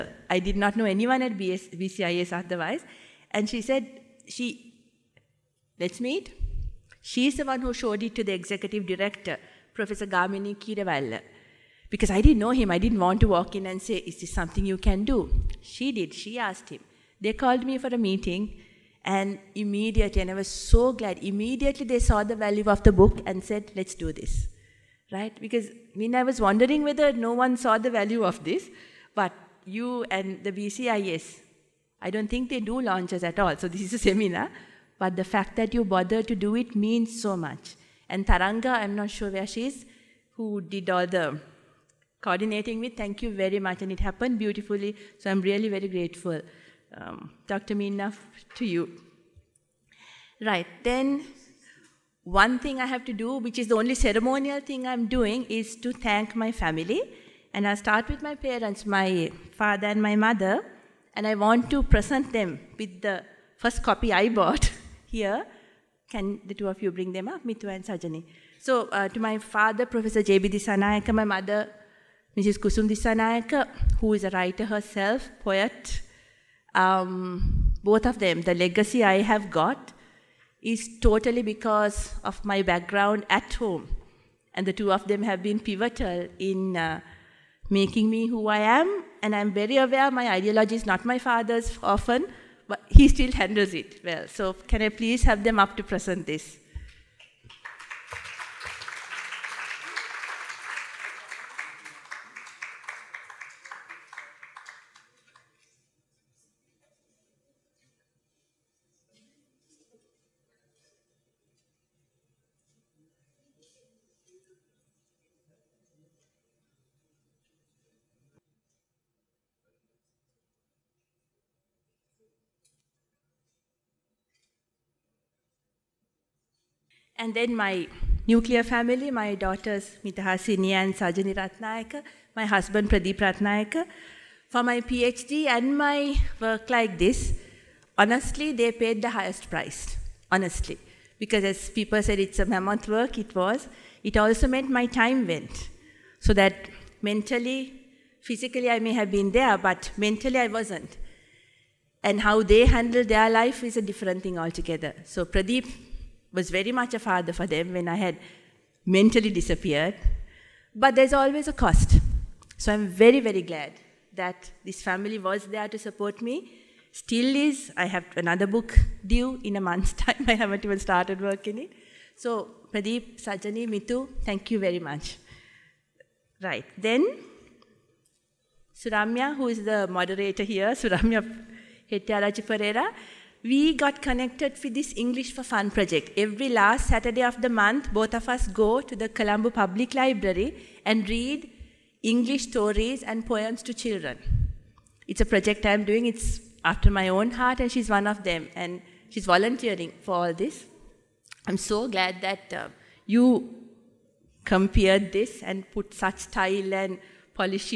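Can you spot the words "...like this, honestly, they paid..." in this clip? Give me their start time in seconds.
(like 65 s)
136 s.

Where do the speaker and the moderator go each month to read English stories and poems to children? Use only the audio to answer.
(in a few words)
Colombo Public Library.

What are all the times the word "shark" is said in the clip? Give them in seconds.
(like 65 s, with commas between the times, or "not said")
not said.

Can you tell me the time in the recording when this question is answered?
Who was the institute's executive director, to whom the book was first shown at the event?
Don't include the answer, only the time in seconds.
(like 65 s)
9 s.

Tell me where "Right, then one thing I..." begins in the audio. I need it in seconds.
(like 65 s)
50 s.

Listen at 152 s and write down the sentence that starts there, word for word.
And how they handle their life is a different thing altogether.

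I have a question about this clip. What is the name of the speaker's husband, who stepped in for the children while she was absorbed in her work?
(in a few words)
Pradeep Ratnayaka.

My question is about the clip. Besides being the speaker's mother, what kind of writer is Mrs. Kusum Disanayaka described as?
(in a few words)
Poet.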